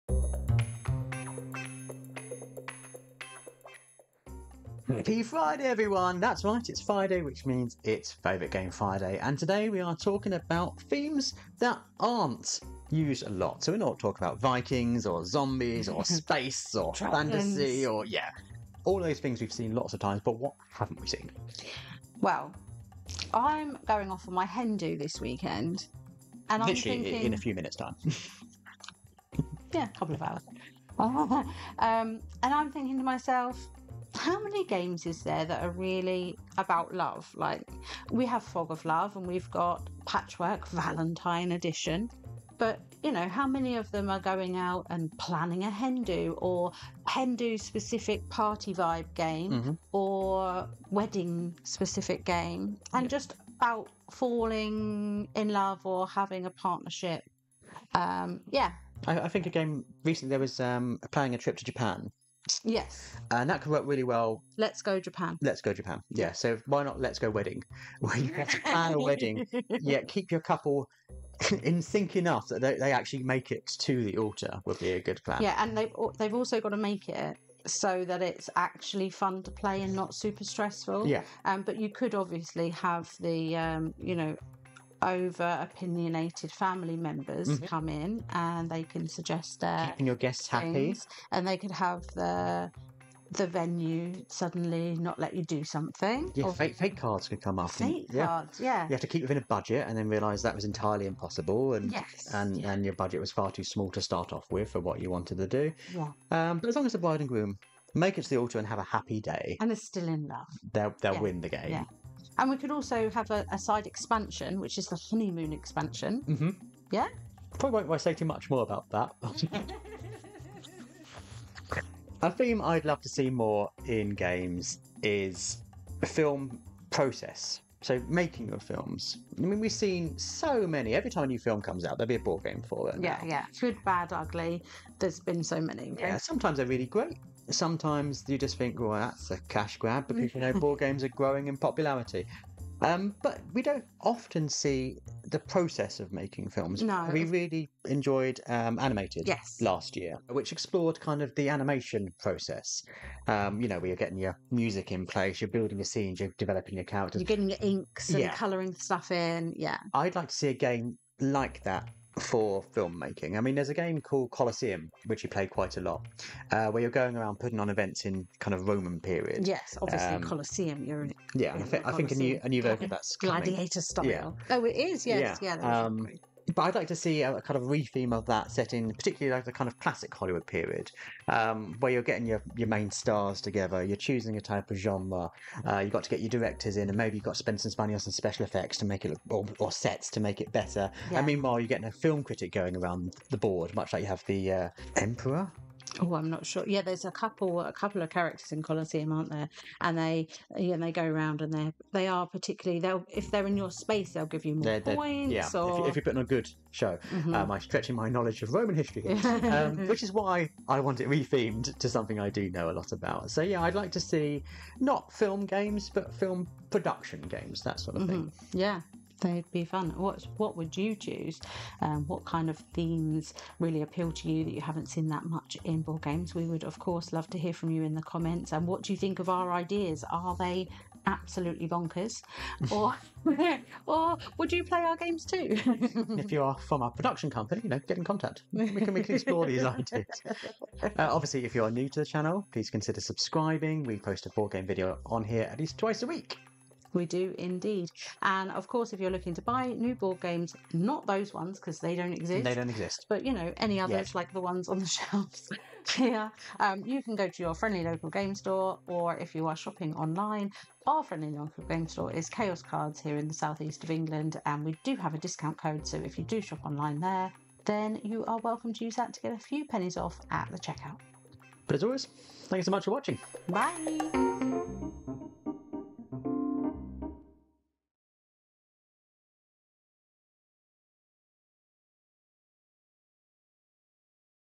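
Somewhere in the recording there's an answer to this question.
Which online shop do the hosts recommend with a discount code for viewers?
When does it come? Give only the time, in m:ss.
4:22.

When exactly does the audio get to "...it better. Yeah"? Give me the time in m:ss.
3:10.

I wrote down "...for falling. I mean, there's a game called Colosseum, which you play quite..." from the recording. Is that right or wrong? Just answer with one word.
wrong.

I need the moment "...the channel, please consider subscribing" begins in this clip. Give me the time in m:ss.
4:01.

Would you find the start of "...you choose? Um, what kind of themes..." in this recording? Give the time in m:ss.
3:40.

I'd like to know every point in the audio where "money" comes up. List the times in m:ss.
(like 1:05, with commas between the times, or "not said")
3:07.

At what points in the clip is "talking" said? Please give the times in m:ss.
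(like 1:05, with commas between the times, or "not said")
0:09, 0:13.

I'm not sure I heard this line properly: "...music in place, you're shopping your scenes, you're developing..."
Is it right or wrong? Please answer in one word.
wrong.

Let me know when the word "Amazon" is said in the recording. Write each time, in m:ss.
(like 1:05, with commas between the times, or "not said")
not said.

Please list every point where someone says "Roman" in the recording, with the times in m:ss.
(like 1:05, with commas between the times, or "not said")
2:48, 3:28.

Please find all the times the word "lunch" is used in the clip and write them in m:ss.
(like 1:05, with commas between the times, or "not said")
not said.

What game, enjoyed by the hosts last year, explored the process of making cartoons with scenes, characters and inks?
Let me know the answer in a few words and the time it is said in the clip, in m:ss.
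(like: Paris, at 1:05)
Animated, at 2:28.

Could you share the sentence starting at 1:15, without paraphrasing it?
Yeah, and they've they've also got to make it so that it's actually fun to play and not super stressful.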